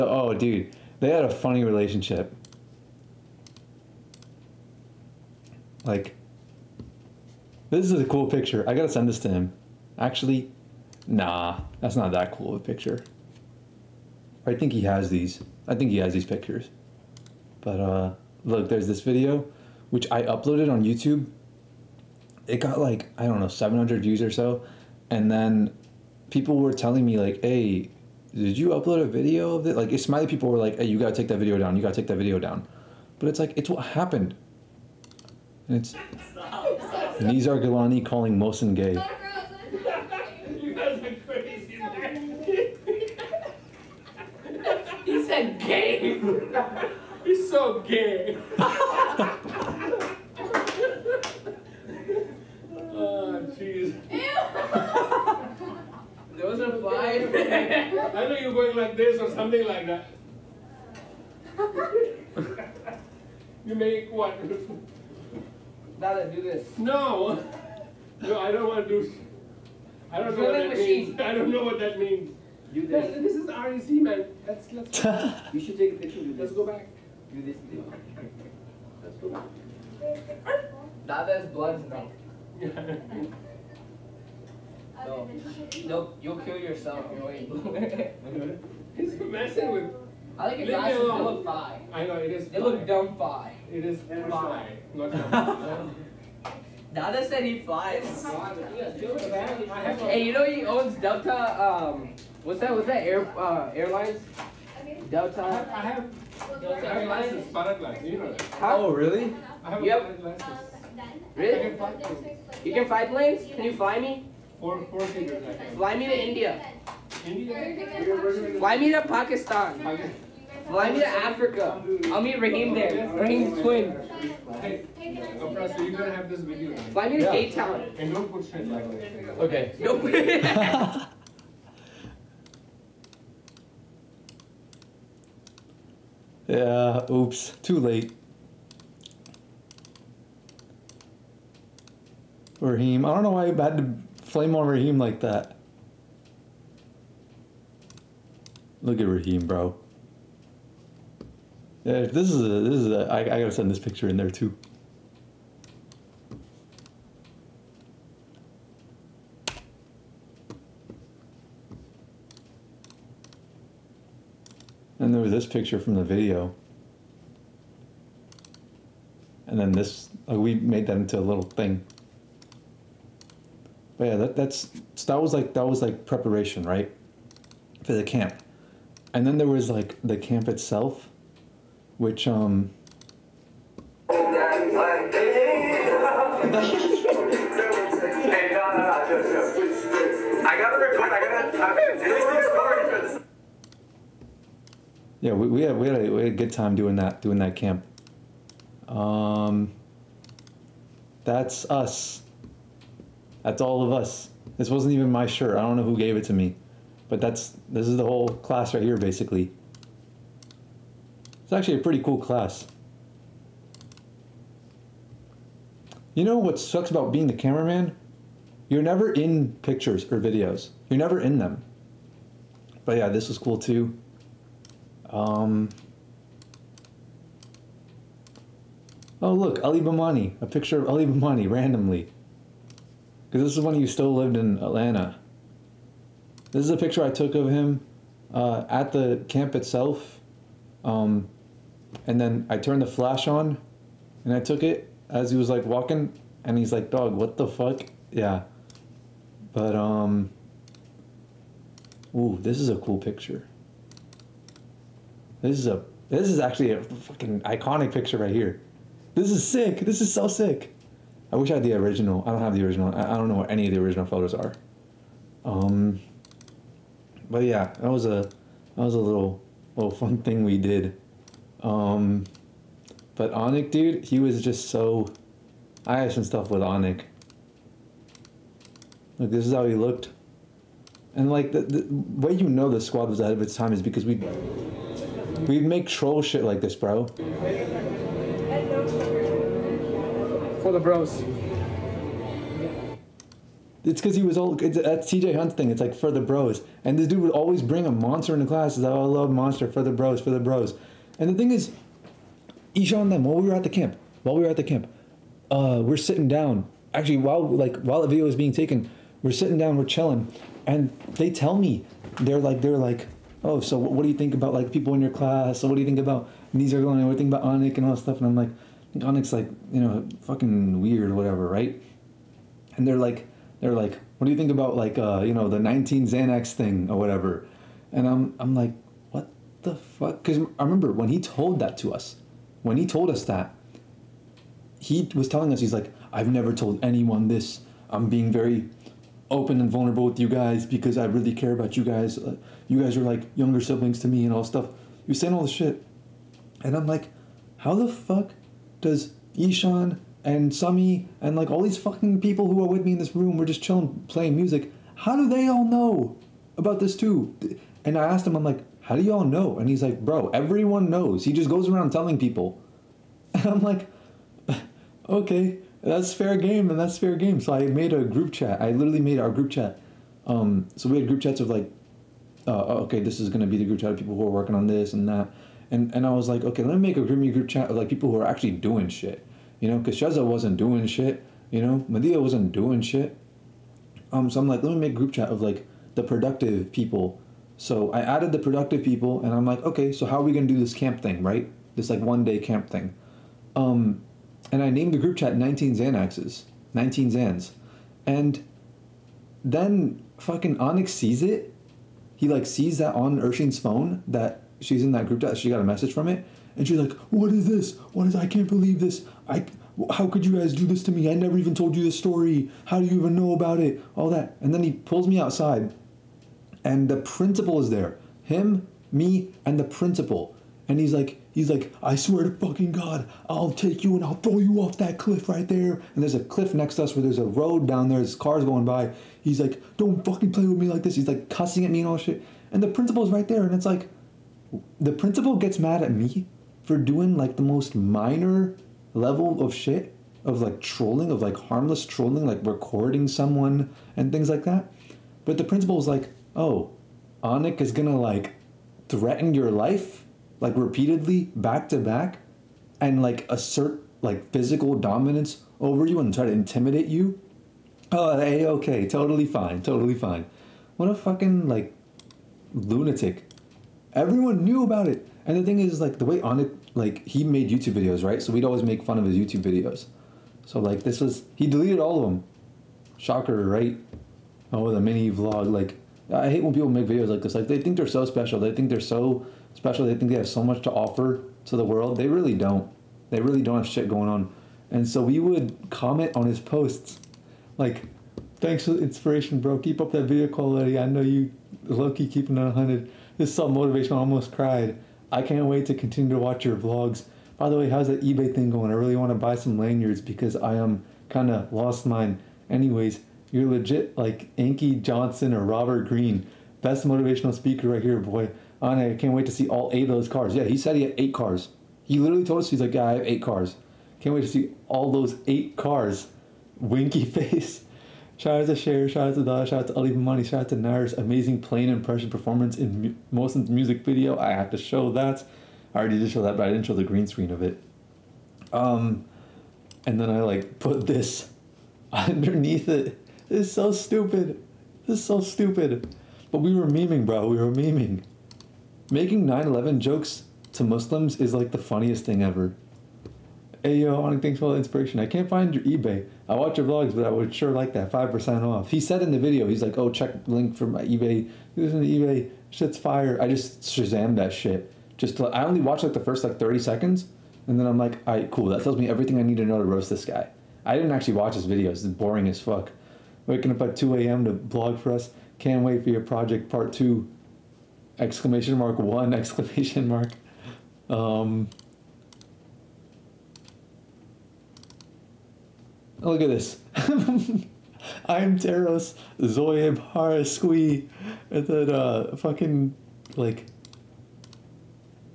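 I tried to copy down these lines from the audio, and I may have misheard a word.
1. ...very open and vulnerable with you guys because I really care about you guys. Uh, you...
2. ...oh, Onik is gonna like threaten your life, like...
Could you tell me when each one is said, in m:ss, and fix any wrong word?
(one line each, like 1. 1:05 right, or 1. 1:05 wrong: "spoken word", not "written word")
1. 5:38 right
2. 7:26 right.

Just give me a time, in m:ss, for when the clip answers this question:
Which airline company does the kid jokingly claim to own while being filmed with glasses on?
1:46.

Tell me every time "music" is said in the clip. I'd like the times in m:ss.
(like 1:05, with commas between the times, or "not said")
5:54, 8:43.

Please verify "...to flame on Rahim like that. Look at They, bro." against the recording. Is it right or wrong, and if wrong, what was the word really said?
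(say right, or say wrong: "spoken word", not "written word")
wrong: "Rahim", not "They".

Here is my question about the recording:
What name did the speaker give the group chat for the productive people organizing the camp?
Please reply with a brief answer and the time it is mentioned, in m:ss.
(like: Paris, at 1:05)
19 Xanaxes, at 6:35.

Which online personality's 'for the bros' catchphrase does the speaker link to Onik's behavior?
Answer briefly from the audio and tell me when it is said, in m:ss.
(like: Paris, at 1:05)
TJ Hunt, at 4:55.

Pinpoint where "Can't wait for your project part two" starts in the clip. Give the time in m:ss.
9:25.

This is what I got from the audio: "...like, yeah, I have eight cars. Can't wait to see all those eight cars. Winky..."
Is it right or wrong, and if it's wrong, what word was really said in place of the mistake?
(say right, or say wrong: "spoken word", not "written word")
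right.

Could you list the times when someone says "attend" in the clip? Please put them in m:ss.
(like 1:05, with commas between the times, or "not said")
not said.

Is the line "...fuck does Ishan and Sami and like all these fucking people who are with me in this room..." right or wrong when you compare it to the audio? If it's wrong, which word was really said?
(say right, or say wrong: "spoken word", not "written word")
right.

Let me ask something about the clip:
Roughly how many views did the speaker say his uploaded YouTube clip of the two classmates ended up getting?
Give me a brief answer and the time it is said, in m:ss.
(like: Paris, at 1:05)
700, at 0:23.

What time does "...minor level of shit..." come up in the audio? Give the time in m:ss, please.
7:17.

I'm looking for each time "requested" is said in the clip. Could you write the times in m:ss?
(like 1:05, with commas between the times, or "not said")
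not said.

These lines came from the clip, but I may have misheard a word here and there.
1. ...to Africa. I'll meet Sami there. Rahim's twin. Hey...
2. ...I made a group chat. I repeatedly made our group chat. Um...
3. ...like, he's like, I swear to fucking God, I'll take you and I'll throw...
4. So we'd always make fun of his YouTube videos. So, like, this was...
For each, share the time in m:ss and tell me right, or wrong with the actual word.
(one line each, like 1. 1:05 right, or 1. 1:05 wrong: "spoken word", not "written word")
1. 2:00 wrong: "Rahim", not "Sami"
2. 6:07 wrong: "literally", not "repeatedly"
3. 7:00 right
4. 7:48 right.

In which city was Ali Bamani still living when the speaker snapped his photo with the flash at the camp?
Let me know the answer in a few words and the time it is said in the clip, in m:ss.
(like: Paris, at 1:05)
Atlanta, at 3:54.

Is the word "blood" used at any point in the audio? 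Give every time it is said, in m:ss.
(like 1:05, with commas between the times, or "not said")
1:21.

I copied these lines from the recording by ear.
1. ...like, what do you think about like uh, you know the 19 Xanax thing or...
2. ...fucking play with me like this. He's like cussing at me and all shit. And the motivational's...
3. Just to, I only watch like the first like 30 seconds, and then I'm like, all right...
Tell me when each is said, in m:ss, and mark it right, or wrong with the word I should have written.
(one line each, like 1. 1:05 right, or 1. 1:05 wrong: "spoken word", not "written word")
1. 5:23 right
2. 7:10 wrong: "principal", not "motivational"
3. 9:14 right.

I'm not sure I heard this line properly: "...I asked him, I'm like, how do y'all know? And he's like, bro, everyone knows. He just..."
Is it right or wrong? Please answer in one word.
right.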